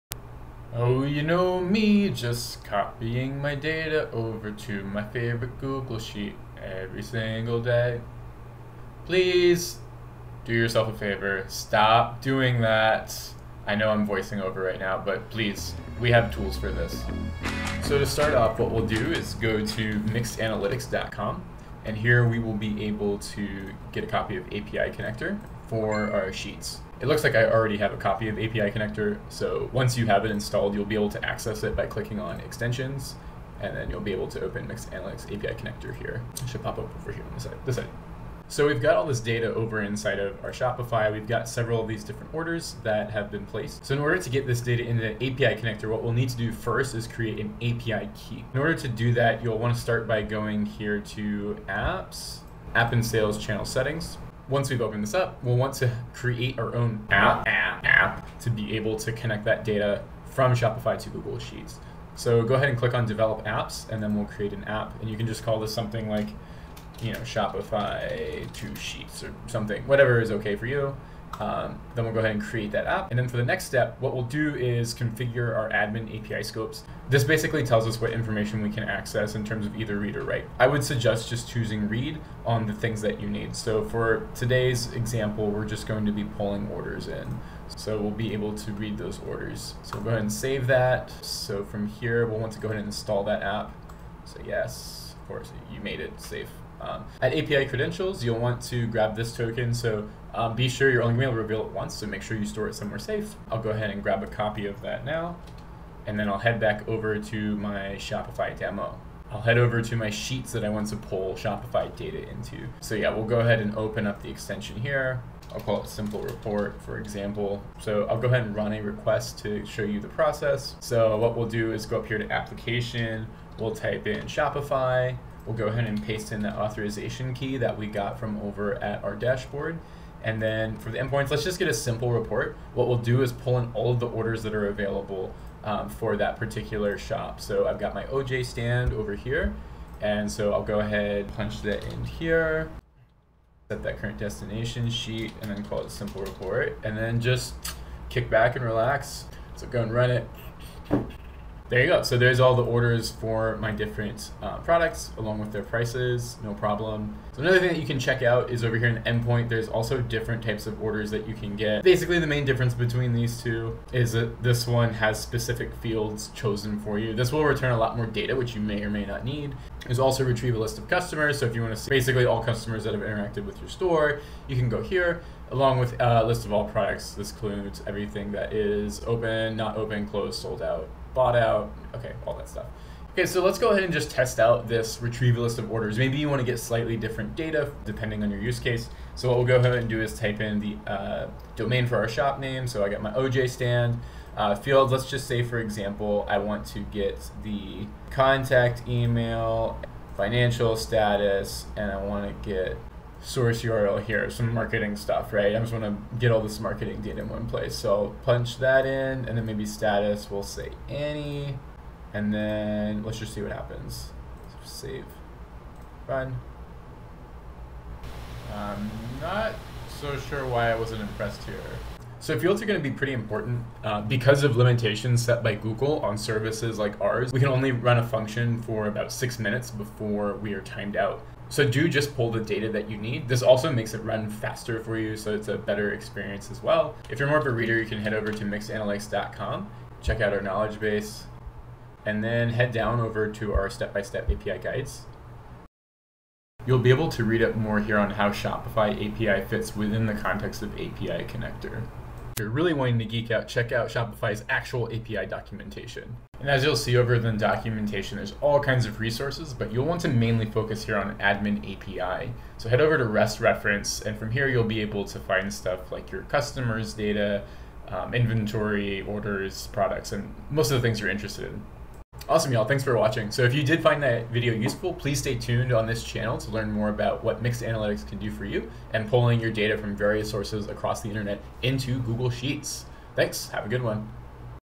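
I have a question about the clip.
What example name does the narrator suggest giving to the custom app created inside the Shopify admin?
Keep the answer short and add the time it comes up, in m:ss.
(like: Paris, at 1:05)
Shopify to Sheets, at 1:07.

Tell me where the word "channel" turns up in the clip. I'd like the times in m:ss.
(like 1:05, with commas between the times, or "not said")
0:53, 4:36.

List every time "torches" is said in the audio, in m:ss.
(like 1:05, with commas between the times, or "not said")
not said.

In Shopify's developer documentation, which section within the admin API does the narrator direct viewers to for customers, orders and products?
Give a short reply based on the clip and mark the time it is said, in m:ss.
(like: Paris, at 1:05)
REST reference, at 4:23.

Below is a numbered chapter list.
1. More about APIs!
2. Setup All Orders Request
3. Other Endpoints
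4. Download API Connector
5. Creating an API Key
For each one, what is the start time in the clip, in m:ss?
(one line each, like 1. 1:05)
1. 3:56
2. 1:49
3. 2:37
4. 0:18
5. 0:43.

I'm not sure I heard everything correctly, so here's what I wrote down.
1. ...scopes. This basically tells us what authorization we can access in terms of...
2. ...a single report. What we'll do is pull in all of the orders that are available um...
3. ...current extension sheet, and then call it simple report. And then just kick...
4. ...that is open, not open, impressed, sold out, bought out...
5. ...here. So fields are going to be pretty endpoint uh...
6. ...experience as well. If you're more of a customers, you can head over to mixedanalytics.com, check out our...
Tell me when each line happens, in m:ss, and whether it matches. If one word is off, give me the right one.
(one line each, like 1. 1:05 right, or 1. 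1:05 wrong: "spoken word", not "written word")
1. 1:16 wrong: "information", not "authorization"
2. 2:11 wrong: "simple", not "single"
3. 2:23 wrong: "destination", not "extension"
4. 2:58 wrong: "closed", not "impressed"
5. 3:41 wrong: "important", not "endpoint"
6. 3:55 wrong: "reader", not "customers".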